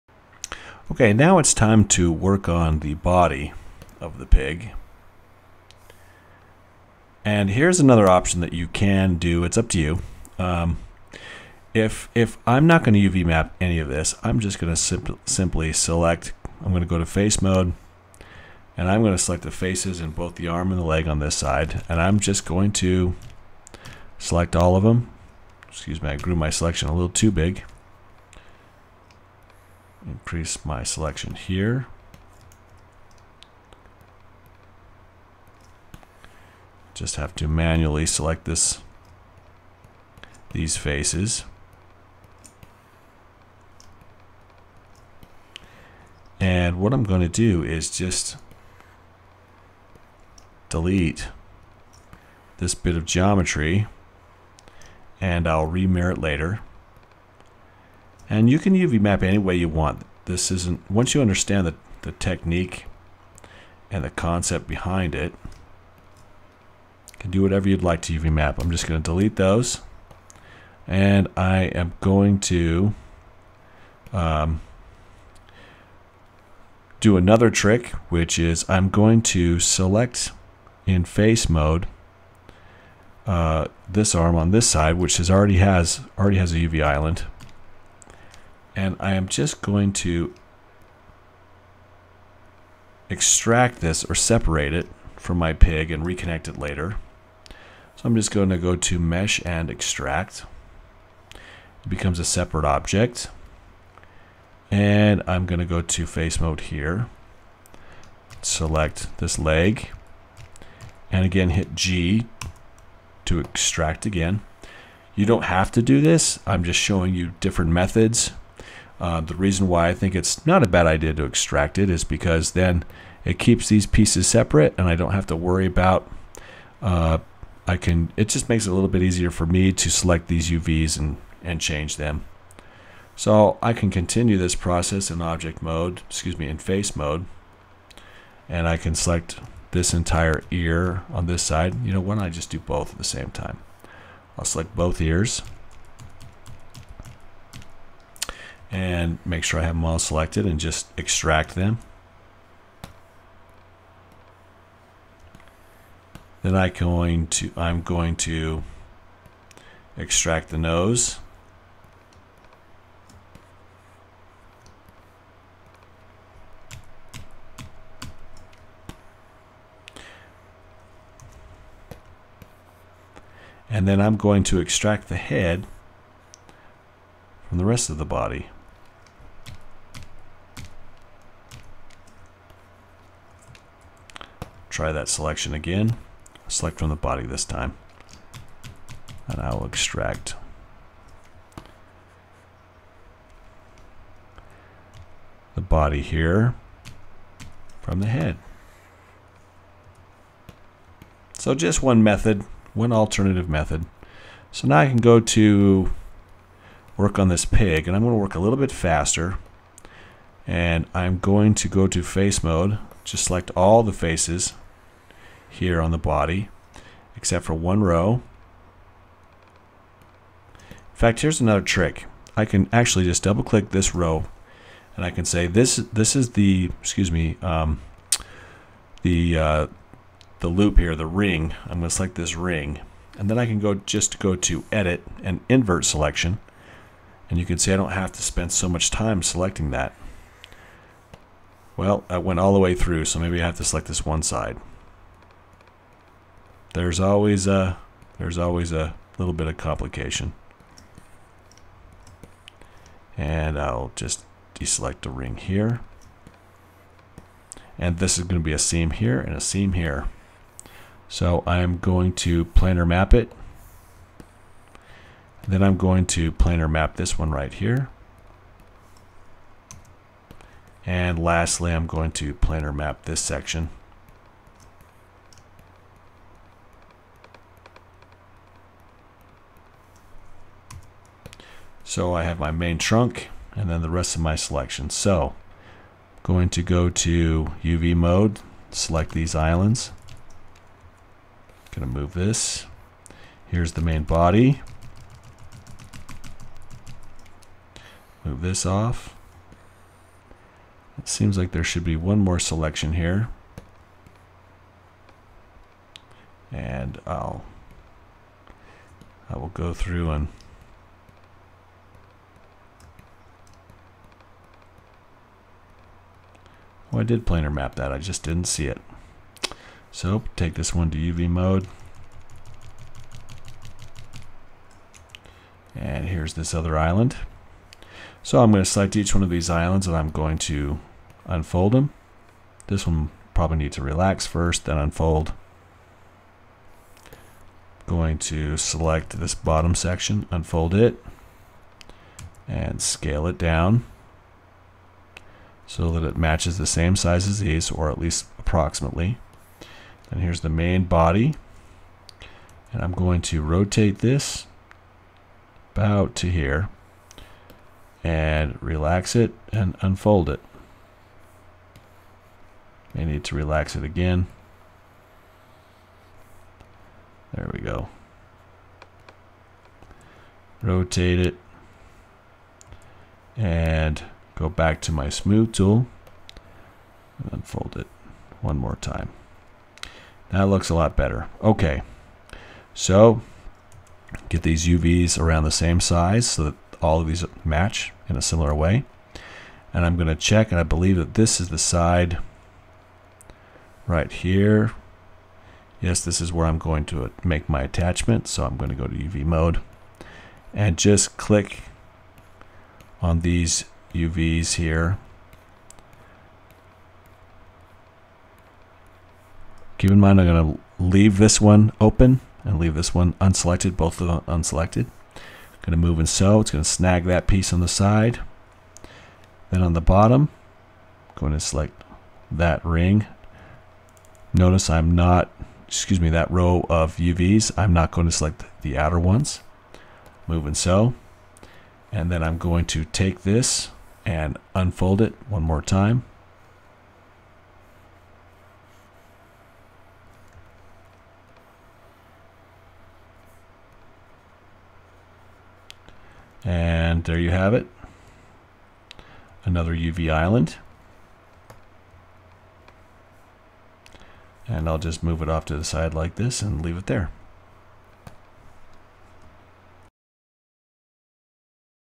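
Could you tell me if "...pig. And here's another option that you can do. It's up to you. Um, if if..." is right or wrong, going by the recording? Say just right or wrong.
right.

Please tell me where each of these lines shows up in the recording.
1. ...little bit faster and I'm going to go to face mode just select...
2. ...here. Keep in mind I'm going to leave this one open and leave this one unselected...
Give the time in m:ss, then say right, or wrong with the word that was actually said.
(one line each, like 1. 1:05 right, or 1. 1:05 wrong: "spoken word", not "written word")
1. 3:28 right
2. 6:44 right.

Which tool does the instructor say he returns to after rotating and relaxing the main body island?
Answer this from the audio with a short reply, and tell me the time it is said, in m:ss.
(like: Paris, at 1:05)
smooth tool, at 6:15.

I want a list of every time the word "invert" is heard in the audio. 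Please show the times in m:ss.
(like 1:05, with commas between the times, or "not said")
3:55.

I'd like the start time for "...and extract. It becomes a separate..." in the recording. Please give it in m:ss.
1:39.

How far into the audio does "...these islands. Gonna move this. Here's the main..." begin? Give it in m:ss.
4:49.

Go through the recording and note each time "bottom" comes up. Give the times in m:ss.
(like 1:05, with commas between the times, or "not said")
5:39, 6:59.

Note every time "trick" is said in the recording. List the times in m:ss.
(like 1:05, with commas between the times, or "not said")
1:17, 3:41.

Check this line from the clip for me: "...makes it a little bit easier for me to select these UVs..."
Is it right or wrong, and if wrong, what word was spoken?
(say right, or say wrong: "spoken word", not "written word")
right.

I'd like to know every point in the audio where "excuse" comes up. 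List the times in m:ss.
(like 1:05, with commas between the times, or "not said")
0:25, 2:16, 3:46, 7:05.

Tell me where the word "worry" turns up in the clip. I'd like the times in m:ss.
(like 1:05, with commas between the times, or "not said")
2:05.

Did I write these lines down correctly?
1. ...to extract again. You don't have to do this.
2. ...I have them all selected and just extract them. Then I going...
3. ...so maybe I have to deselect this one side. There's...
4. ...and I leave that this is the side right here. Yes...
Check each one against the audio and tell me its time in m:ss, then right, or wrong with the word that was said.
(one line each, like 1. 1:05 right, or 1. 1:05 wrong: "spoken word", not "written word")
1. 1:53 right
2. 2:29 right
3. 4:03 wrong: "select", not "deselect"
4. 6:30 wrong: "believe", not "leave".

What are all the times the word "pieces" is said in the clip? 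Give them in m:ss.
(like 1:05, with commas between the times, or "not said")
2:03, 6:57.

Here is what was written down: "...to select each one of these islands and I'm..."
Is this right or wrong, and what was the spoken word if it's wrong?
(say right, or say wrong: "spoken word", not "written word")
right.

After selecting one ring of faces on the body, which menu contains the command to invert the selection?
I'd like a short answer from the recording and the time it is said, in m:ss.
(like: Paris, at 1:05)
edit, at 3:54.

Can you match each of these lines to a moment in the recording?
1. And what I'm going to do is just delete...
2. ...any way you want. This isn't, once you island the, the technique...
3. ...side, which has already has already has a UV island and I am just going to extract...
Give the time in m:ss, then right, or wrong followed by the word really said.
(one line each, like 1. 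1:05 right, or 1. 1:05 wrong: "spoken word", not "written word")
1. 0:46 right
2. 0:59 wrong: "understand", not "island"
3. 1:24 right.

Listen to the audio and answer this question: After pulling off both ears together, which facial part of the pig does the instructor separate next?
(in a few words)
the nose.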